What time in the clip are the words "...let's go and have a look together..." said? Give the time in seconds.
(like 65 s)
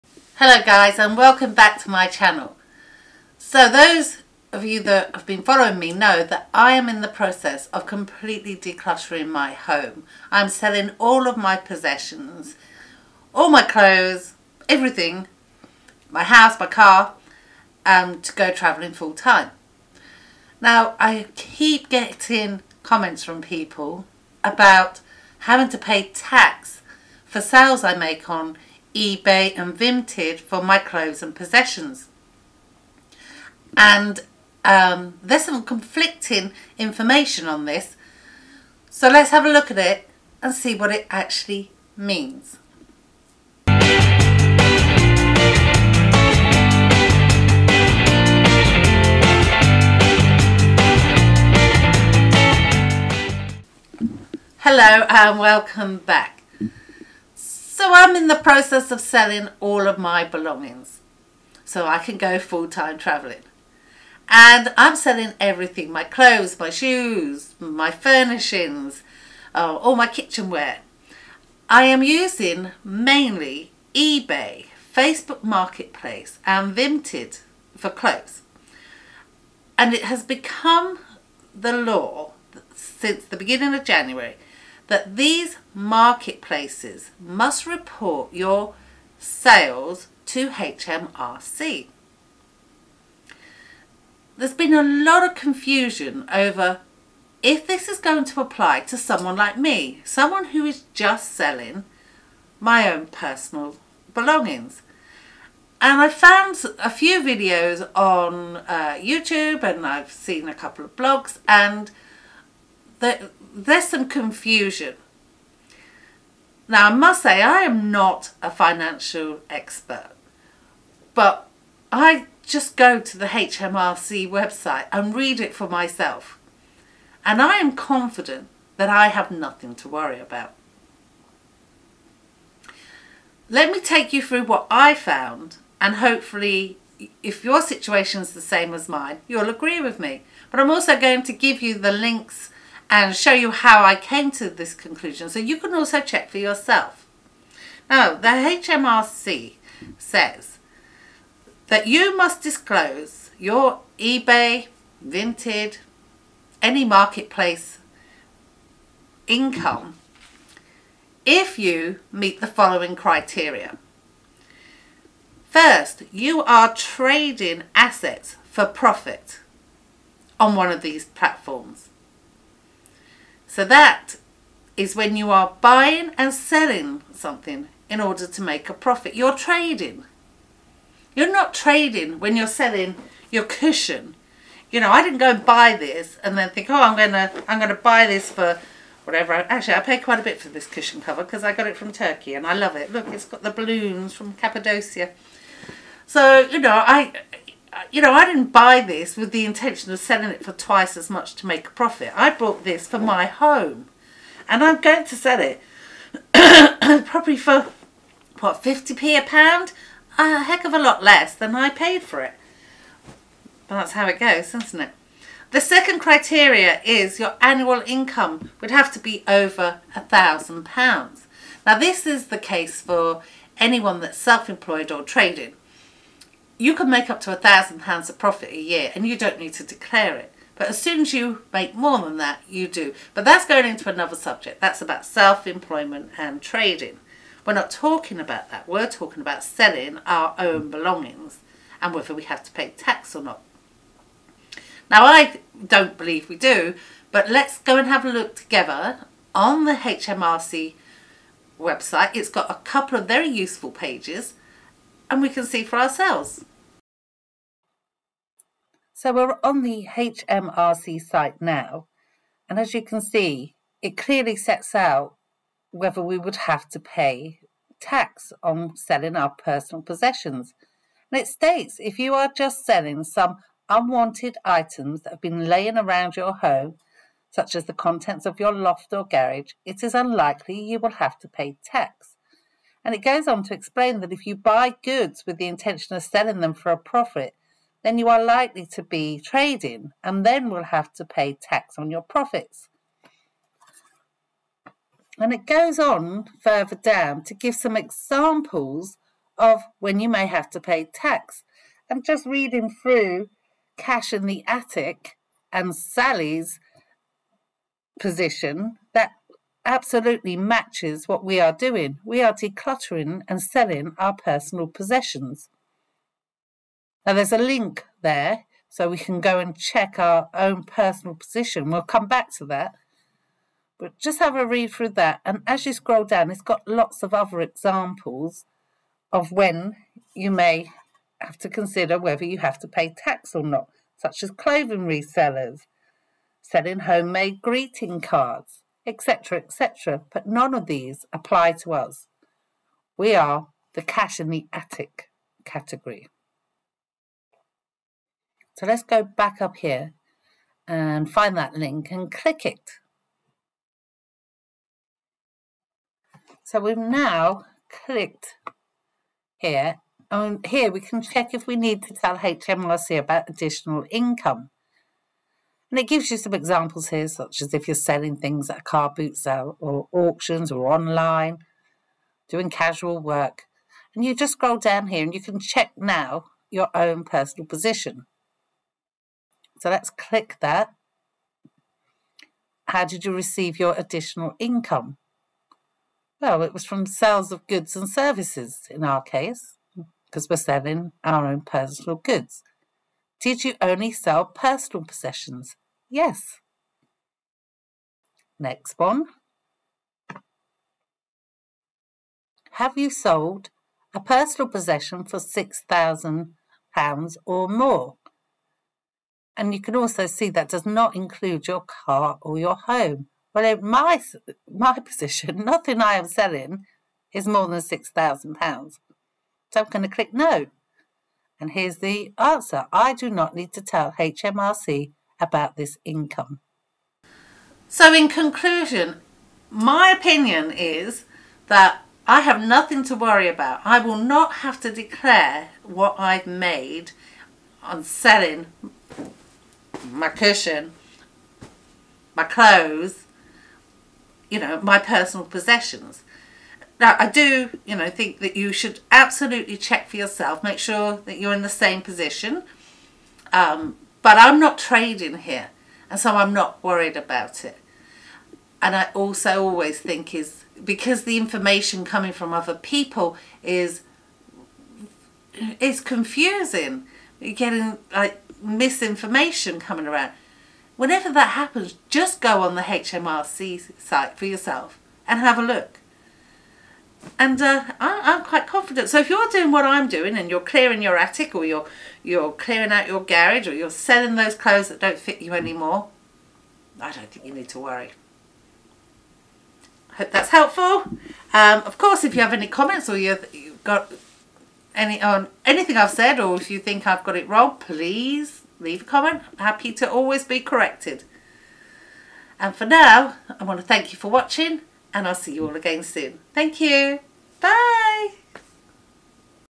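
247 s.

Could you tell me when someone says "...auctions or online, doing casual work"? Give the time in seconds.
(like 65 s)
369 s.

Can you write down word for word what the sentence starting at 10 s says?
I'm selling all of my possessions, all my clothes, everything, my house, my car, um, to go travelling full time.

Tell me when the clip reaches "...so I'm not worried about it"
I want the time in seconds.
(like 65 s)
455 s.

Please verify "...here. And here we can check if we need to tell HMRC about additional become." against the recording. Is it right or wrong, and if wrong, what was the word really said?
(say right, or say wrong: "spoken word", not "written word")
wrong: "income", not "become".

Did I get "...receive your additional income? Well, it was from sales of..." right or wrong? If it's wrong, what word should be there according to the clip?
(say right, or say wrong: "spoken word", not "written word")
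right.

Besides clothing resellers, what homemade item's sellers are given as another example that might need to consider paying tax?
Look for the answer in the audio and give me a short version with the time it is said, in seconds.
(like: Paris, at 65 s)
greeting cards, at 337 s.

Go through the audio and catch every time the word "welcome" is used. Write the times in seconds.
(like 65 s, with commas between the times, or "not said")
1 s, 55 s.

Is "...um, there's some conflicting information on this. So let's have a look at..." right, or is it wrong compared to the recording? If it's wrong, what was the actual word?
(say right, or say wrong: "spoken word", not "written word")
right.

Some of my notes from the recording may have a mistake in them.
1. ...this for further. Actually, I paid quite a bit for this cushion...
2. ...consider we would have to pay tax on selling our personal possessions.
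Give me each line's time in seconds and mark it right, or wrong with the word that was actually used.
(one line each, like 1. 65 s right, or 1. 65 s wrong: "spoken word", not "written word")
1. 188 s wrong: "whatever", not "further"
2. 265 s wrong: "whether", not "consider".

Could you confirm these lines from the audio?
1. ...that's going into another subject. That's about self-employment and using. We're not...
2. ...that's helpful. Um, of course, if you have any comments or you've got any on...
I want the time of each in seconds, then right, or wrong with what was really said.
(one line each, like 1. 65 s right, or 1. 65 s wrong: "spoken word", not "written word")
1. 233 s wrong: "trading", not "using"
2. 490 s right.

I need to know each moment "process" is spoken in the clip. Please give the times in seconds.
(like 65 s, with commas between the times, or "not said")
7 s, 58 s.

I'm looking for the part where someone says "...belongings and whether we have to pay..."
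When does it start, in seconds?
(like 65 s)
240 s.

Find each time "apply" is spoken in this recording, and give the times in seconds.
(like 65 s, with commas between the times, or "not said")
98 s, 341 s.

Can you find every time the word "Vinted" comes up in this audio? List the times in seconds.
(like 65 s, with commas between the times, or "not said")
29 s, 76 s, 155 s.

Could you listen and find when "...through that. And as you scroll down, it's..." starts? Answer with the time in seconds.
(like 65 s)
324 s.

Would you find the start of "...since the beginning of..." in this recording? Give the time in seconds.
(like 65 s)
82 s.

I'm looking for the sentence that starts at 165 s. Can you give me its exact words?
First, you are trading assets for profit on one of these platforms.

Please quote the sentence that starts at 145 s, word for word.
So you can also check for yourself.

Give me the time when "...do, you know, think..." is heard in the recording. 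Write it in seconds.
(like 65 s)
447 s.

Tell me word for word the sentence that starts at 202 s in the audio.
I bought this for my home.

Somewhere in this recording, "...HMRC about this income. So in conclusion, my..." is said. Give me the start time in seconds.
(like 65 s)
423 s.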